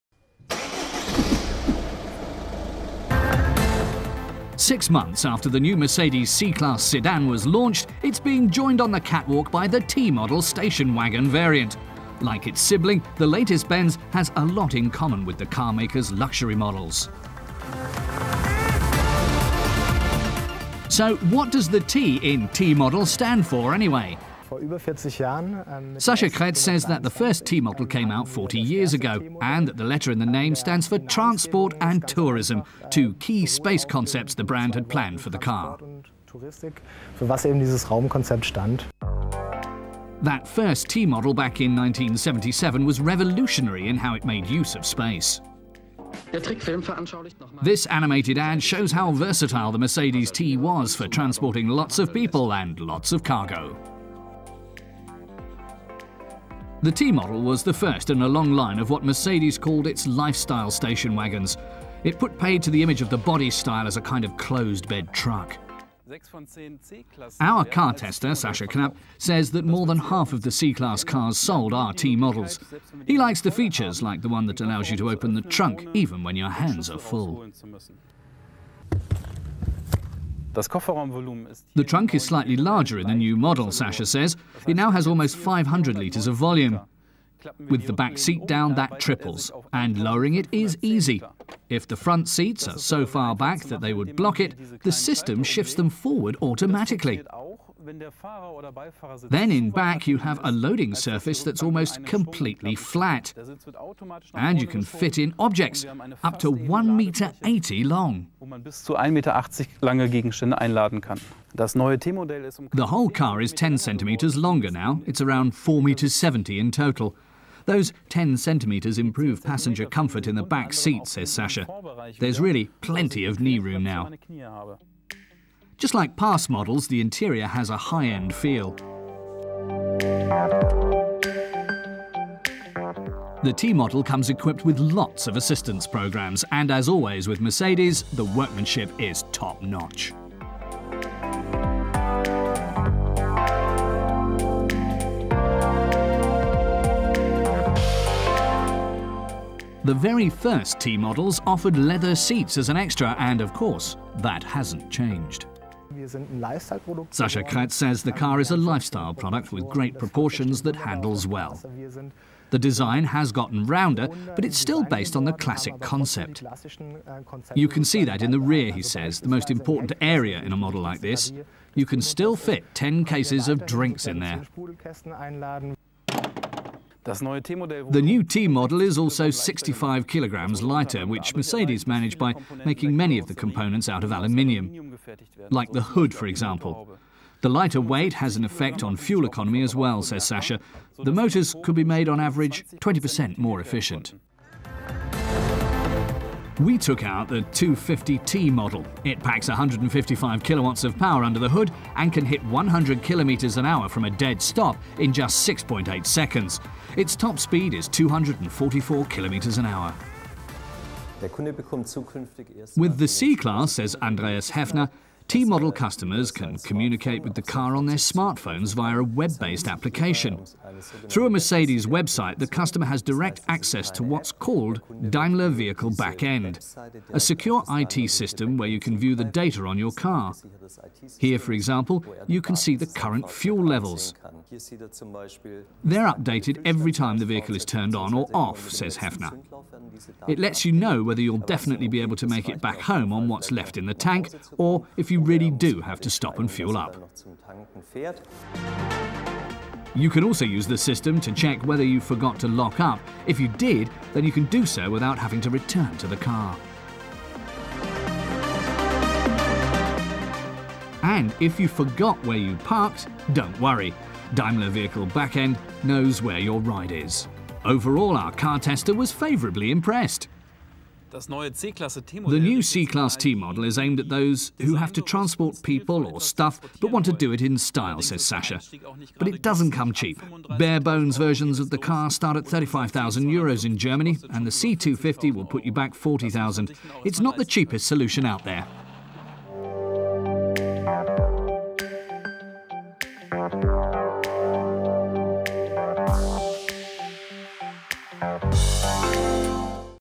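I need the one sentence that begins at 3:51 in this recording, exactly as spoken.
Here, for example, you can see the current fuel levels.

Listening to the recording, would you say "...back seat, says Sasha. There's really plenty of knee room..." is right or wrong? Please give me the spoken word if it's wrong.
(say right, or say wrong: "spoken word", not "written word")
right.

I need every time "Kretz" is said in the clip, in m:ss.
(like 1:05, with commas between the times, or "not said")
0:26, 2:37.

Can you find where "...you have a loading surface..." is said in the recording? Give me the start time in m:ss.
1:40.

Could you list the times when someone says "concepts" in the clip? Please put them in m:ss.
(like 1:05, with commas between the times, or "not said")
0:33, 2:45.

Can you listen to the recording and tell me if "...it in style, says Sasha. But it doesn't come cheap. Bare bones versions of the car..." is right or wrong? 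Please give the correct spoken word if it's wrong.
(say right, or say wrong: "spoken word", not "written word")
right.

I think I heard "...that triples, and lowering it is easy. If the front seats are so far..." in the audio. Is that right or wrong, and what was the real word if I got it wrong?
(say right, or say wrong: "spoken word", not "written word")
right.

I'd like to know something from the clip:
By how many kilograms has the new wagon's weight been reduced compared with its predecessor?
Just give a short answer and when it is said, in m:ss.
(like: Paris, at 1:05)
65, at 2:59.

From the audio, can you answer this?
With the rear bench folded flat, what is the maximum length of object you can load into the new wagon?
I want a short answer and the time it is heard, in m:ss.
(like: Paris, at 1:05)
1.80 meters, at 1:46.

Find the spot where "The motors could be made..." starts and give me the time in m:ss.
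3:11.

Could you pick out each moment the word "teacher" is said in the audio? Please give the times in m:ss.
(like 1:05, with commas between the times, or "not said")
not said.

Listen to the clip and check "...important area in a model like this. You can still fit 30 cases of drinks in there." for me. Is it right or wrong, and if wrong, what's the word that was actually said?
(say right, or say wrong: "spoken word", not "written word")
wrong: "10", not "30".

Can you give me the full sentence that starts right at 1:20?
The trunk is slightly larger in the new model, Sasha says.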